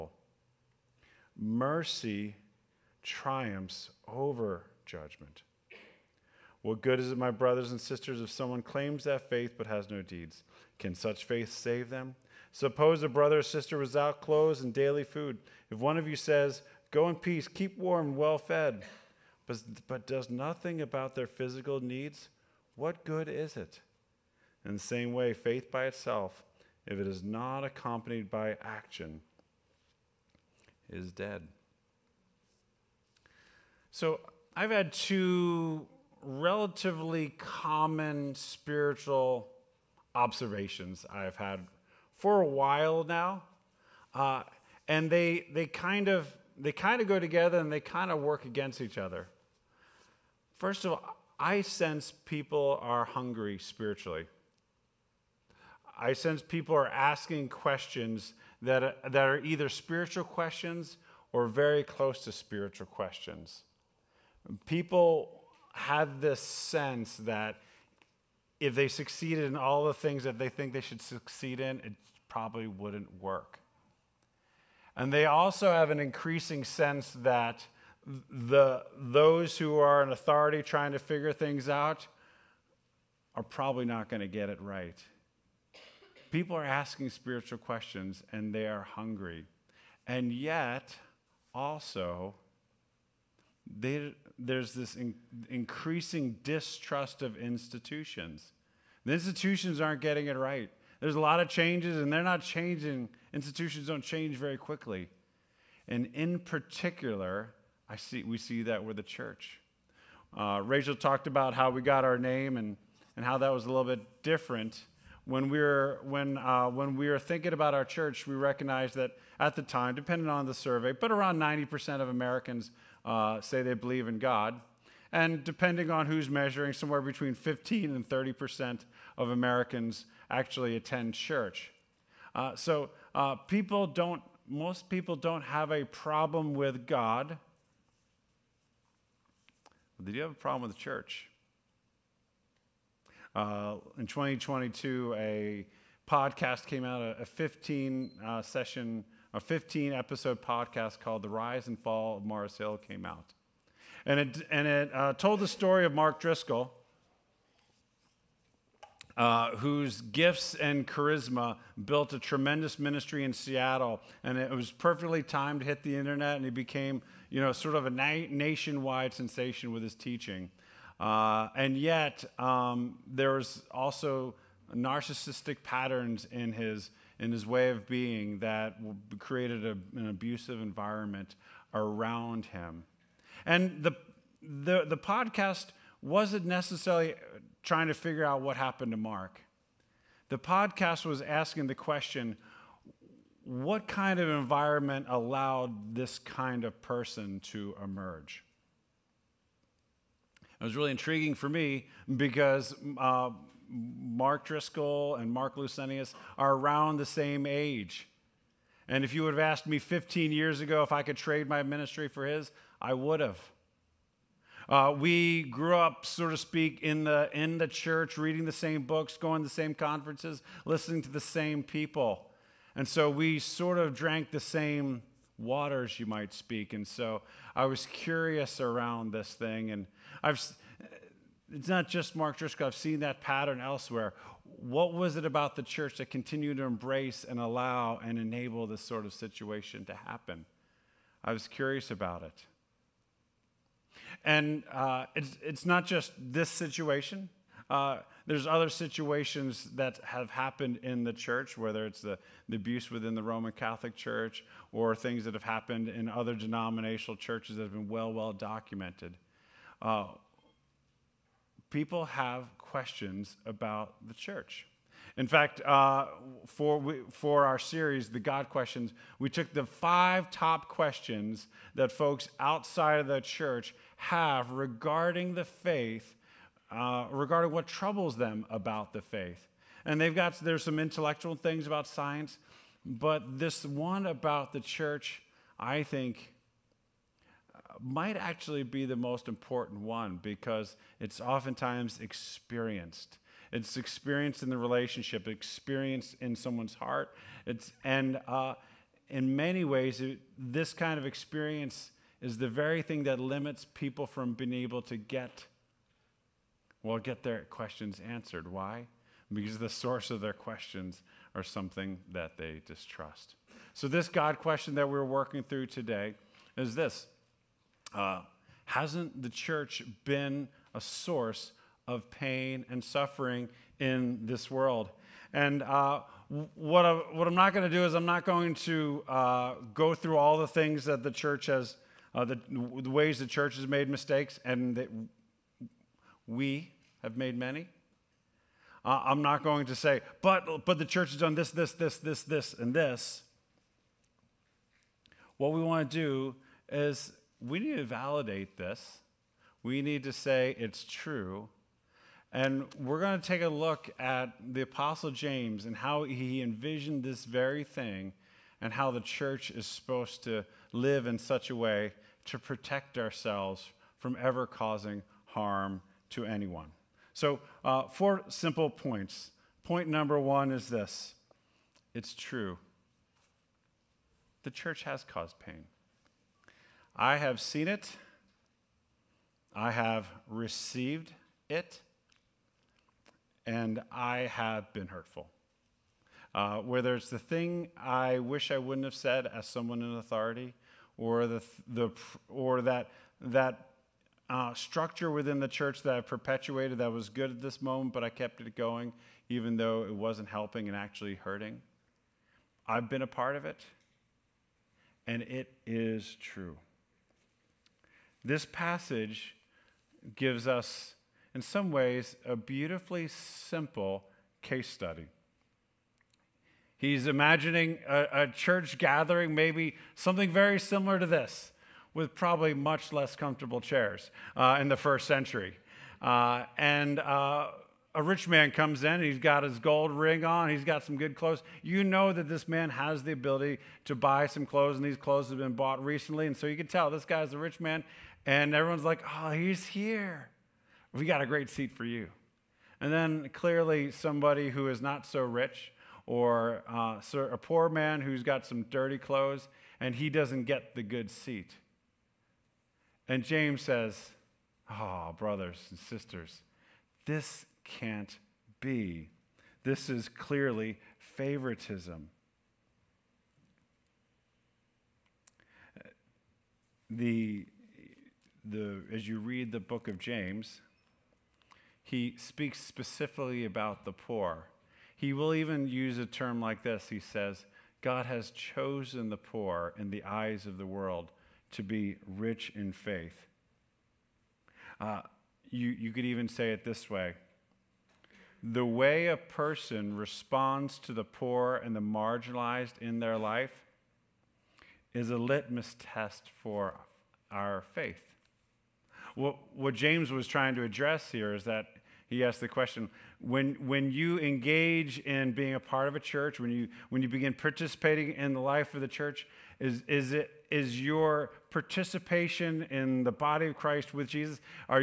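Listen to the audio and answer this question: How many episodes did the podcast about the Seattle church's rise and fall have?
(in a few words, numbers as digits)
15.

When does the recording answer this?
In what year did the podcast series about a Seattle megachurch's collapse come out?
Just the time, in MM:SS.
02:24.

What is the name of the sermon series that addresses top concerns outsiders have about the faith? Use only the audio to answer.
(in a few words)
The God Questions.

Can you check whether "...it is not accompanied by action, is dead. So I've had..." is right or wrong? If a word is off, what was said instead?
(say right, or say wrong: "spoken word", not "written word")
right.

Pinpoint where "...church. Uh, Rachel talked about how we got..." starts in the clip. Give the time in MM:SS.
01:49.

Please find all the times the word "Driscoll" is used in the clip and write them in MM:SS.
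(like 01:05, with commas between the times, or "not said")
02:36, 03:24, 03:52.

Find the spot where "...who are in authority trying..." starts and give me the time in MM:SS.
01:19.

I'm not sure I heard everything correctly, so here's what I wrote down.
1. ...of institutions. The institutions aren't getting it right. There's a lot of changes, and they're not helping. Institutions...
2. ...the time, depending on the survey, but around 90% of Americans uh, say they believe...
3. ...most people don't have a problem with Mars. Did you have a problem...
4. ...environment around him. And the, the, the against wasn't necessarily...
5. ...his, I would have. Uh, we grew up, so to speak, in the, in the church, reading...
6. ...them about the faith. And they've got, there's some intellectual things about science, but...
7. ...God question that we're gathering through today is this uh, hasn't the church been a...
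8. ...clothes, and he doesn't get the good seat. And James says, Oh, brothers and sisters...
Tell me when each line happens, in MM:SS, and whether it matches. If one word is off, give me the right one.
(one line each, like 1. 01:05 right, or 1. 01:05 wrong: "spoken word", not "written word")
1. 01:37 wrong: "changing", not "helping"
2. 01:59 right
3. 02:14 wrong: "God", not "Mars"
4. 03:00 wrong: "podcast", not "against"
5. 03:32 right
6. 04:38 right
7. 05:14 wrong: "working", not "gathering"
8. 07:28 right.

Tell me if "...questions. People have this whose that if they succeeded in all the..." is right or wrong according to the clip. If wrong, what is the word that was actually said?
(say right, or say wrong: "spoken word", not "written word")
wrong: "sense", not "whose".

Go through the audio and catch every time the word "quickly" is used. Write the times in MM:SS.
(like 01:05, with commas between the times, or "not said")
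01:44.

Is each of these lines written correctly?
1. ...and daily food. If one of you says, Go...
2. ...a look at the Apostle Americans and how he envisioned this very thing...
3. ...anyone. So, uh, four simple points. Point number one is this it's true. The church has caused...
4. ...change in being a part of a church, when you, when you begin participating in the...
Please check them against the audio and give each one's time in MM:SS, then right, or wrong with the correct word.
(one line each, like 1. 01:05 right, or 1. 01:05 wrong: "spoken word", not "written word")
1. 00:14 right
2. 05:53 wrong: "James", not "Americans"
3. 06:06 right
4. 08:24 wrong: "engage", not "change".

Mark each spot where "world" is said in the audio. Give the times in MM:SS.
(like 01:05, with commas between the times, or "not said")
05:24, 08:00.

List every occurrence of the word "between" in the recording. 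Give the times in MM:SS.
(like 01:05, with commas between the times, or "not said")
02:07.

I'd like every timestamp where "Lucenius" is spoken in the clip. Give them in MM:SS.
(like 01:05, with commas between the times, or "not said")
03:25.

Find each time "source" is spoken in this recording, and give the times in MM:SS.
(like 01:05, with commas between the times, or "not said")
05:09, 05:20.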